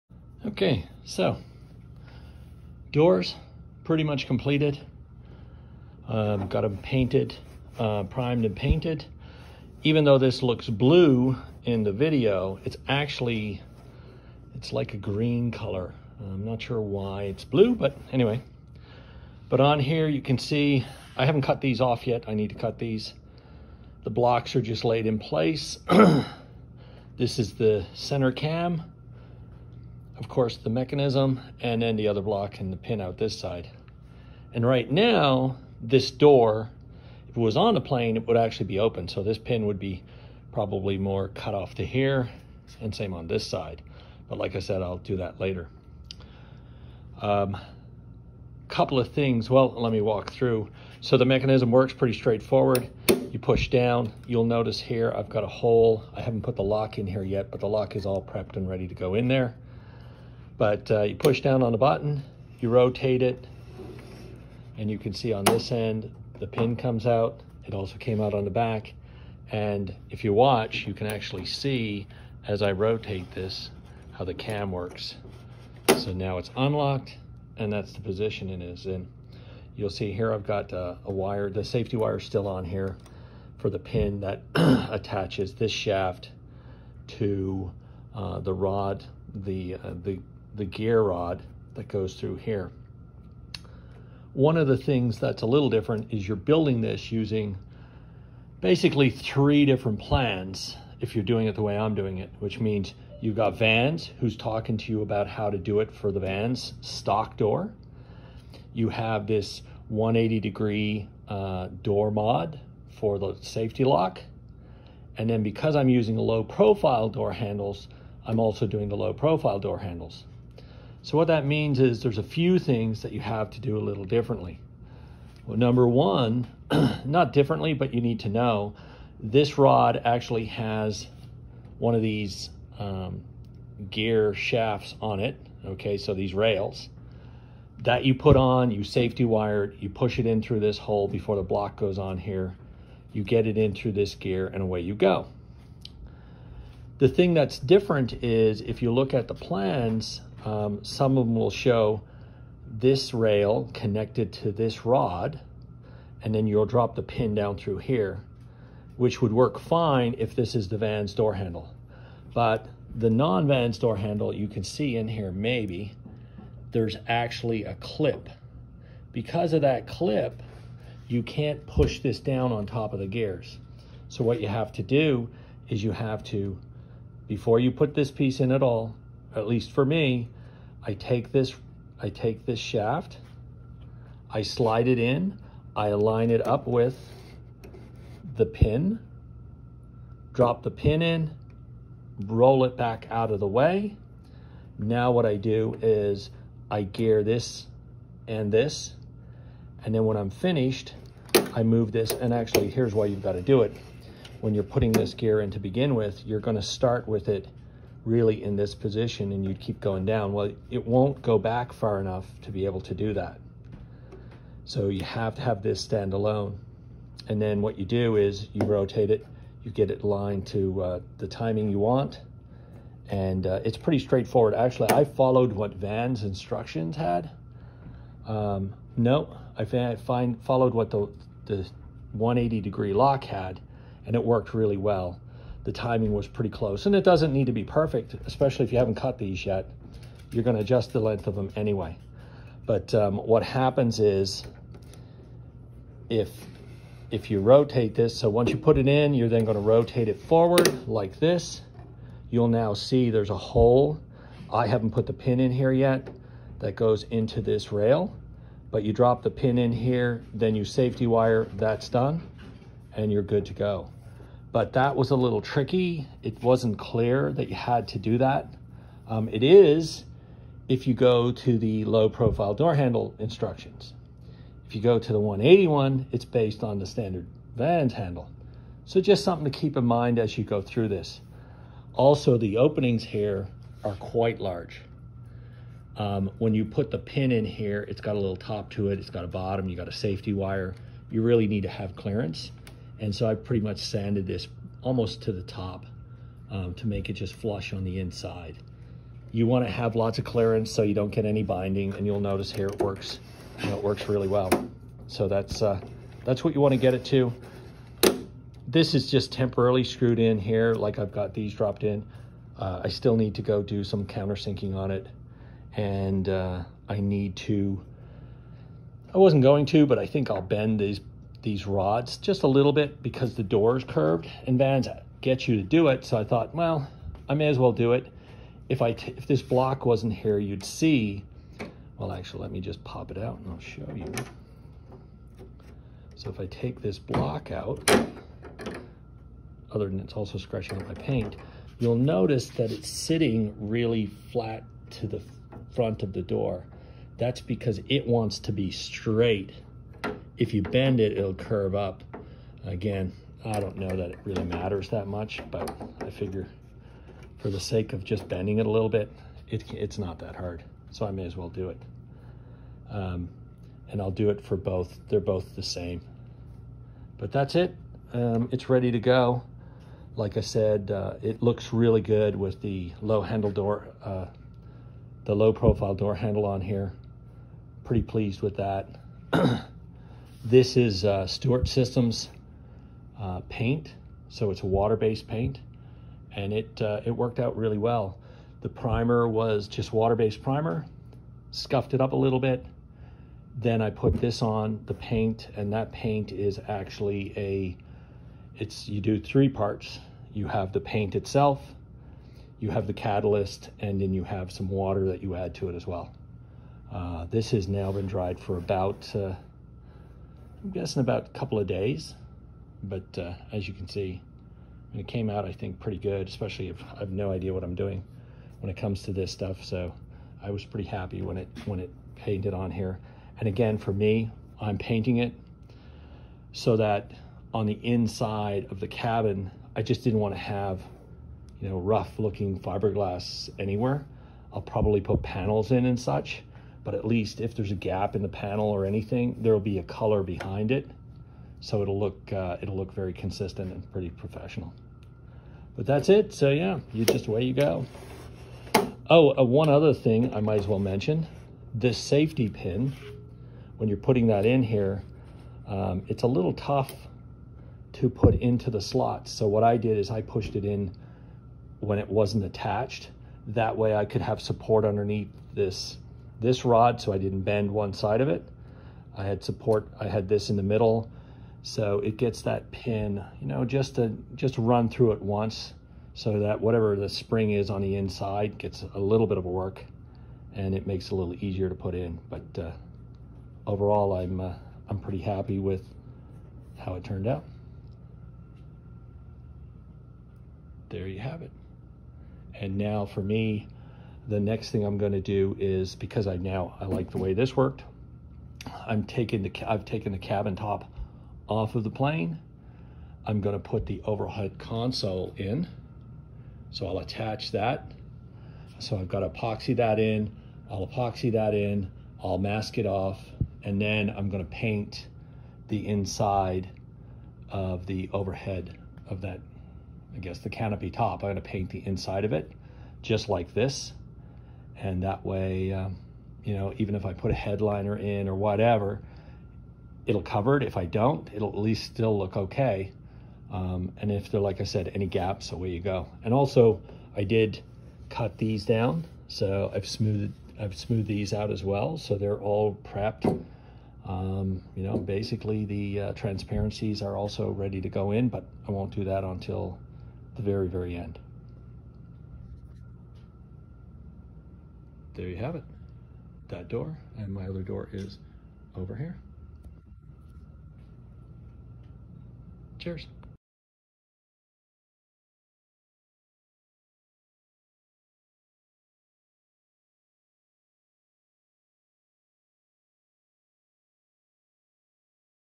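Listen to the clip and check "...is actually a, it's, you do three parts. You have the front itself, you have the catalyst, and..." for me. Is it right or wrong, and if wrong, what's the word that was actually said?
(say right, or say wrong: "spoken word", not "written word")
wrong: "paint", not "front".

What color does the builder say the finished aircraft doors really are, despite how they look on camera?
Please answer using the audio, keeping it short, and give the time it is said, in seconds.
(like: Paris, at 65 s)
green, at 14 s.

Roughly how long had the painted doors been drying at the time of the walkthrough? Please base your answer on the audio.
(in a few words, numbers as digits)
a couple of days.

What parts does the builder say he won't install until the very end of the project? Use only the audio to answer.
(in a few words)
transparencies.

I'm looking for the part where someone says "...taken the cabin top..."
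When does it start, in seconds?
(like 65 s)
499 s.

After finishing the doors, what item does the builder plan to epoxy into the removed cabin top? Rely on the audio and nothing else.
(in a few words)
overhead console.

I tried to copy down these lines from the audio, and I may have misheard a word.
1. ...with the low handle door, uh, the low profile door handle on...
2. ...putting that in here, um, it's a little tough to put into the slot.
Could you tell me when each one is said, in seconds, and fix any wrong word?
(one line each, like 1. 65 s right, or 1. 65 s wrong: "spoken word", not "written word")
1. 372 s right
2. 453 s right.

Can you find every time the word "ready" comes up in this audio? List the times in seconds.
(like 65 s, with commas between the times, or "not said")
58 s, 368 s, 547 s.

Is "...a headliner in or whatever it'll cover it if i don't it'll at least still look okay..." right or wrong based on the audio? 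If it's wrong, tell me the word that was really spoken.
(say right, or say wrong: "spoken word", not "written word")
right.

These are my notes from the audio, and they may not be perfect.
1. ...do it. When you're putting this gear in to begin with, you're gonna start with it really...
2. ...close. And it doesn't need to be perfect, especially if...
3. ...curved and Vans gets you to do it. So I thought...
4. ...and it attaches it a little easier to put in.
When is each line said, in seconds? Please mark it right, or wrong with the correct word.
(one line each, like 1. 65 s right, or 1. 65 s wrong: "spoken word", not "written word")
1. 203 s right
2. 236 s right
3. 323 s right
4. 480 s wrong: "makes", not "attaches".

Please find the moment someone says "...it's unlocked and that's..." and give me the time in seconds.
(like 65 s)
76 s.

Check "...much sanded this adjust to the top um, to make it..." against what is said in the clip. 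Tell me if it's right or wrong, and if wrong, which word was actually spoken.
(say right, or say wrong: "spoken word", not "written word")
wrong: "almost", not "adjust".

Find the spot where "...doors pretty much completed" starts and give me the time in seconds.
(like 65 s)
2 s.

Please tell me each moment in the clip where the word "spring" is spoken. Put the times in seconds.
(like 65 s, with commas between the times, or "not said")
477 s.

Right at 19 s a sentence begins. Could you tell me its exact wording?
But on here you can see, I haven't cut these off yet.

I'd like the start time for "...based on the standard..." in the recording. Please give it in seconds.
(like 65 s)
276 s.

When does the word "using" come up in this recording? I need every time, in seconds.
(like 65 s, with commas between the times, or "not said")
97 s, 115 s.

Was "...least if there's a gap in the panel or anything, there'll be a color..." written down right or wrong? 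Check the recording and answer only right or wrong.
right.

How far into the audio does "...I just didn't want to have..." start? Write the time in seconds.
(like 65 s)
429 s.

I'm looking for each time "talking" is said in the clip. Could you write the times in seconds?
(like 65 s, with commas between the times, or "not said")
104 s.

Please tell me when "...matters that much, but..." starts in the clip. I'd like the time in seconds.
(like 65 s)
354 s.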